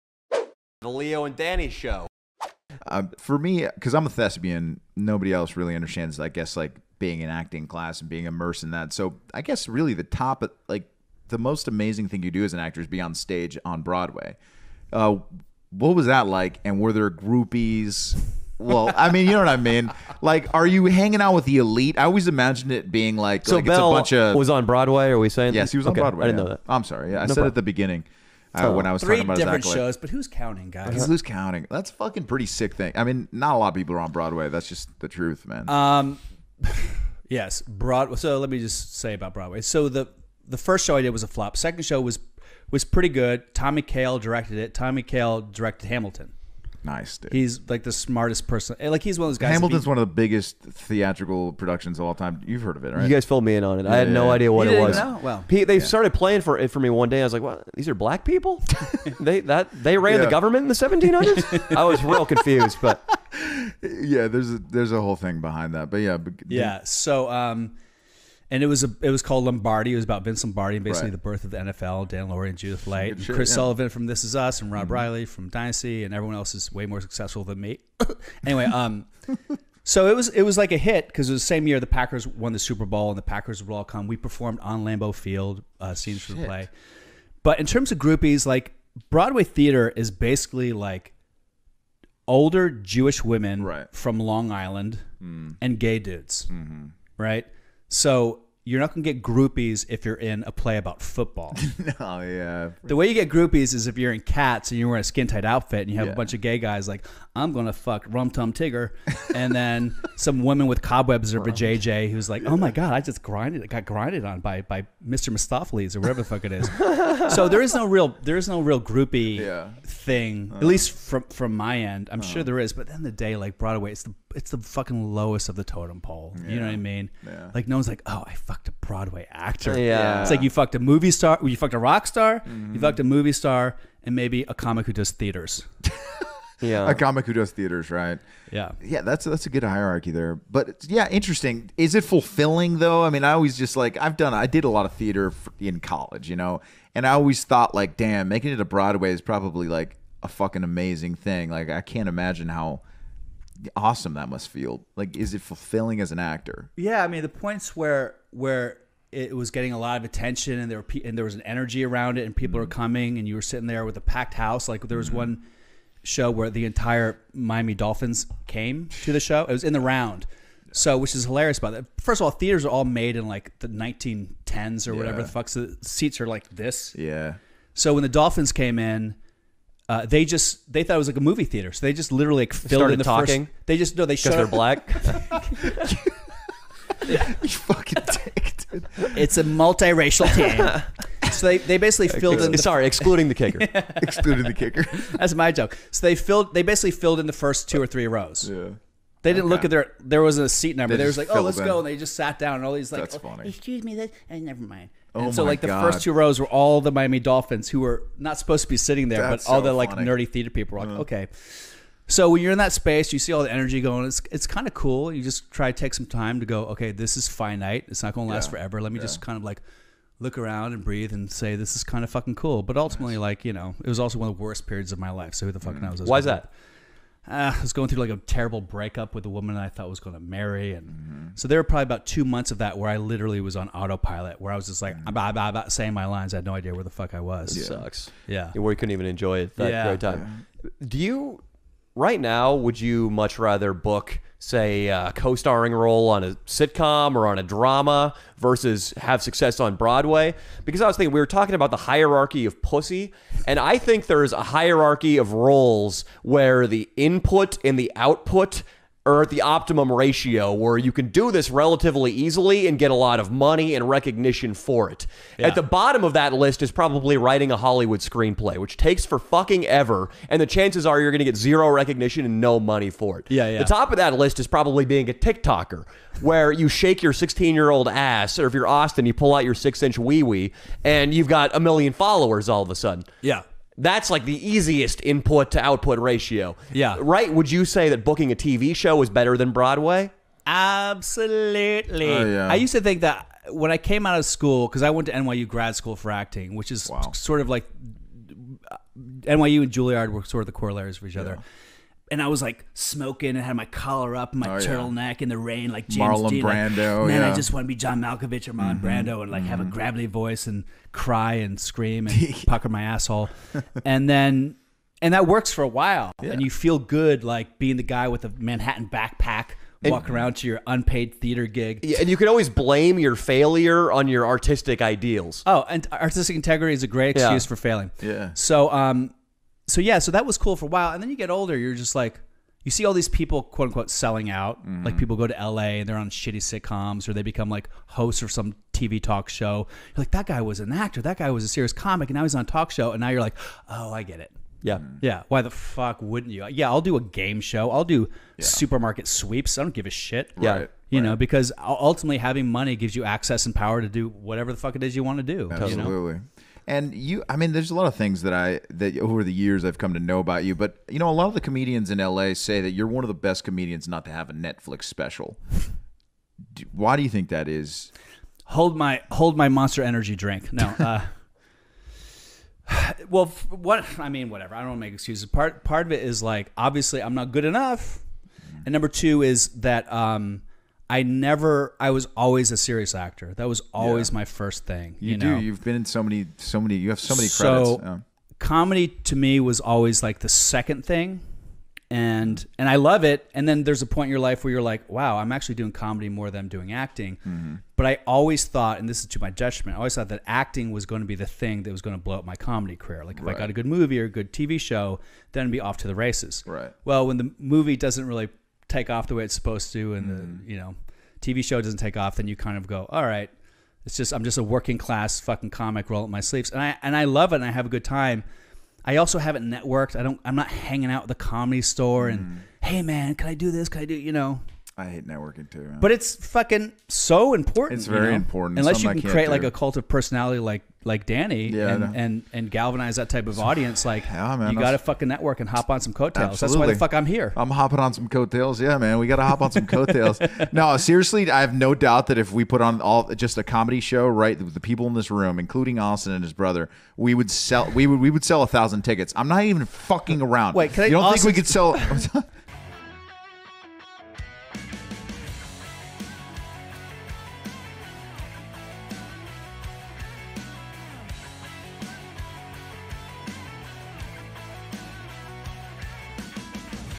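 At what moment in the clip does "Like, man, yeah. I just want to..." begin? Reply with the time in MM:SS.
05:06.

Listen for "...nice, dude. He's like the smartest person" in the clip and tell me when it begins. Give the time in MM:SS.
00:46.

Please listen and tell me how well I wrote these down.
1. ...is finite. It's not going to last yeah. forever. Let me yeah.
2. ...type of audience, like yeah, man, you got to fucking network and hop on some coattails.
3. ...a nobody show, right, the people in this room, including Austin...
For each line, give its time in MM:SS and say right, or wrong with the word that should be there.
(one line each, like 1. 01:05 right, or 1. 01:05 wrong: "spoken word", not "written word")
1. 03:37 right
2. 07:13 right
3. 07:23 wrong: "comedy", not "nobody".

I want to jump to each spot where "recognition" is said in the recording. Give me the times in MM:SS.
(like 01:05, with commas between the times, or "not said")
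04:23, 04:31.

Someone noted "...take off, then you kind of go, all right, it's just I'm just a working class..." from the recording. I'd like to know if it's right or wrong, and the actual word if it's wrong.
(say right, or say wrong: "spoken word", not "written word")
right.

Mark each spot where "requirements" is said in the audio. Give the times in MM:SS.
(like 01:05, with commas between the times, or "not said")
not said.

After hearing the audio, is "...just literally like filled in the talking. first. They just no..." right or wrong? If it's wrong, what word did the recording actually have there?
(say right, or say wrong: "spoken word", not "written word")
right.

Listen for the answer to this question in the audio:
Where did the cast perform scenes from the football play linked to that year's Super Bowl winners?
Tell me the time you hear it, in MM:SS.
01:24.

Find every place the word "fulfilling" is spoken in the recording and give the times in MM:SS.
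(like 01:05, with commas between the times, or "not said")
02:22, 02:35.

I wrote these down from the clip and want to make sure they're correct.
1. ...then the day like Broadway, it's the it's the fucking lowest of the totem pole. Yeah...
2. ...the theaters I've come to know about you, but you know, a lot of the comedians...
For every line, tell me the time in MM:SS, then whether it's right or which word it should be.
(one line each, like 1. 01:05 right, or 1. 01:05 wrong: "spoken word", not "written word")
1. 02:02 right
2. 05:59 wrong: "years", not "theaters".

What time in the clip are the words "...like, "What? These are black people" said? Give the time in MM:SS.
00:57.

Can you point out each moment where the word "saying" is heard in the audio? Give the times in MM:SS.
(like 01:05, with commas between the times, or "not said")
00:25, 03:55.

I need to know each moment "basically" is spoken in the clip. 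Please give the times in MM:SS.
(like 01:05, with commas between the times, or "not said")
01:10, 01:30, 03:11, 03:16.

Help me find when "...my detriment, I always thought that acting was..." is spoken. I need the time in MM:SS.
06:39.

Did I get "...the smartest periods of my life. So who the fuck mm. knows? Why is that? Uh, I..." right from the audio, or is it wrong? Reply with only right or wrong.
wrong.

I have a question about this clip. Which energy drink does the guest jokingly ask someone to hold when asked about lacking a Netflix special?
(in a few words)
Monster Energy.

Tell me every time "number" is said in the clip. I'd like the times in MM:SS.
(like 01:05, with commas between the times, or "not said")
03:20, 06:18.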